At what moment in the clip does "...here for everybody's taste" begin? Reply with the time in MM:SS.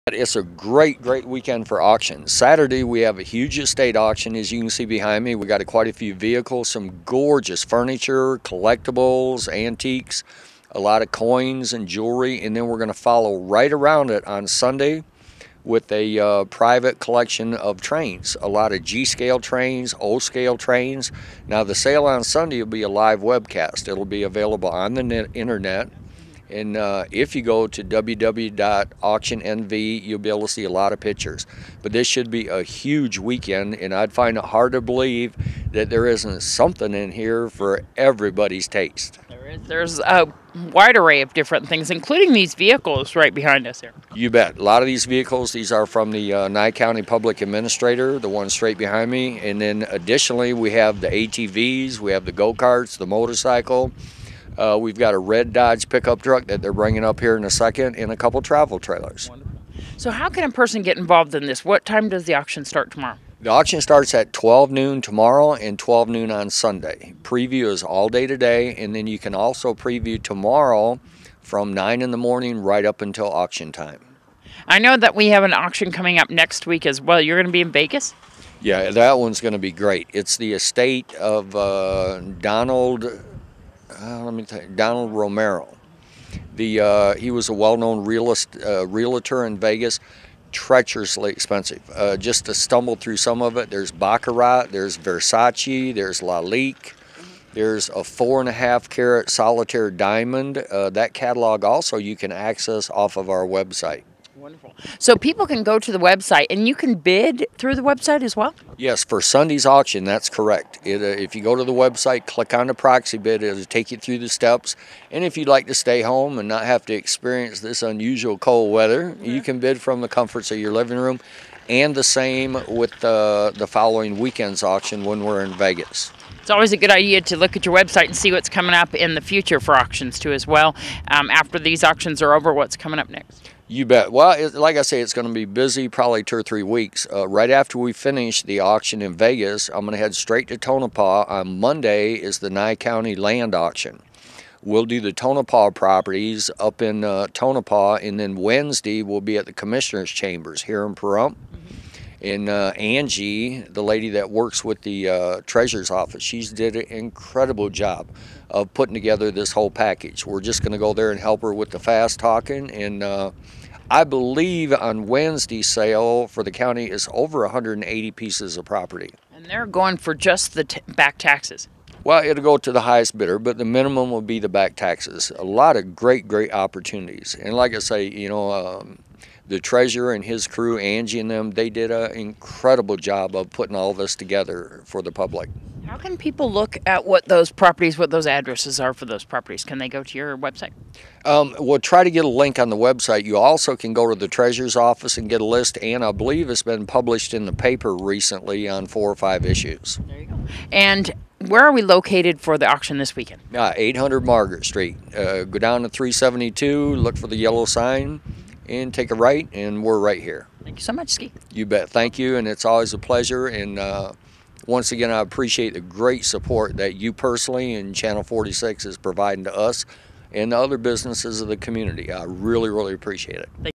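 00:37.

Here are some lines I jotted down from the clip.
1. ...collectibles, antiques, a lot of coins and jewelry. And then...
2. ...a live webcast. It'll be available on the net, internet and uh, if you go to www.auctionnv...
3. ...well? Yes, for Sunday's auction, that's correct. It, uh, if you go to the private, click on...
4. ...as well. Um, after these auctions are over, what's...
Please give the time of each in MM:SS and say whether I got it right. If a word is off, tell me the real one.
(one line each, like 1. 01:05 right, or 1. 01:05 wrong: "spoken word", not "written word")
1. 00:08 right
2. 00:22 right
3. 01:48 wrong: "website", not "private"
4. 02:10 right.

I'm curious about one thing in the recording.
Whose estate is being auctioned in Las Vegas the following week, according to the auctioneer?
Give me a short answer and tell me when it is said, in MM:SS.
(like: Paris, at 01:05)
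Donald Romero, at 01:24.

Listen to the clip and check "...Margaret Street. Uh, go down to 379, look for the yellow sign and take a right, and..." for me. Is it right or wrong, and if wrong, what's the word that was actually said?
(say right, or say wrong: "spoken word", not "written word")
wrong: "372", not "379".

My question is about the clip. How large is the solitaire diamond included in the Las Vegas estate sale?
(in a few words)
4.5 carats.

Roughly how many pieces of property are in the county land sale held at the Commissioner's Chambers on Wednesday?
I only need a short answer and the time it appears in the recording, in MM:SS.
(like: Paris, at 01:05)
over 180, at 02:47.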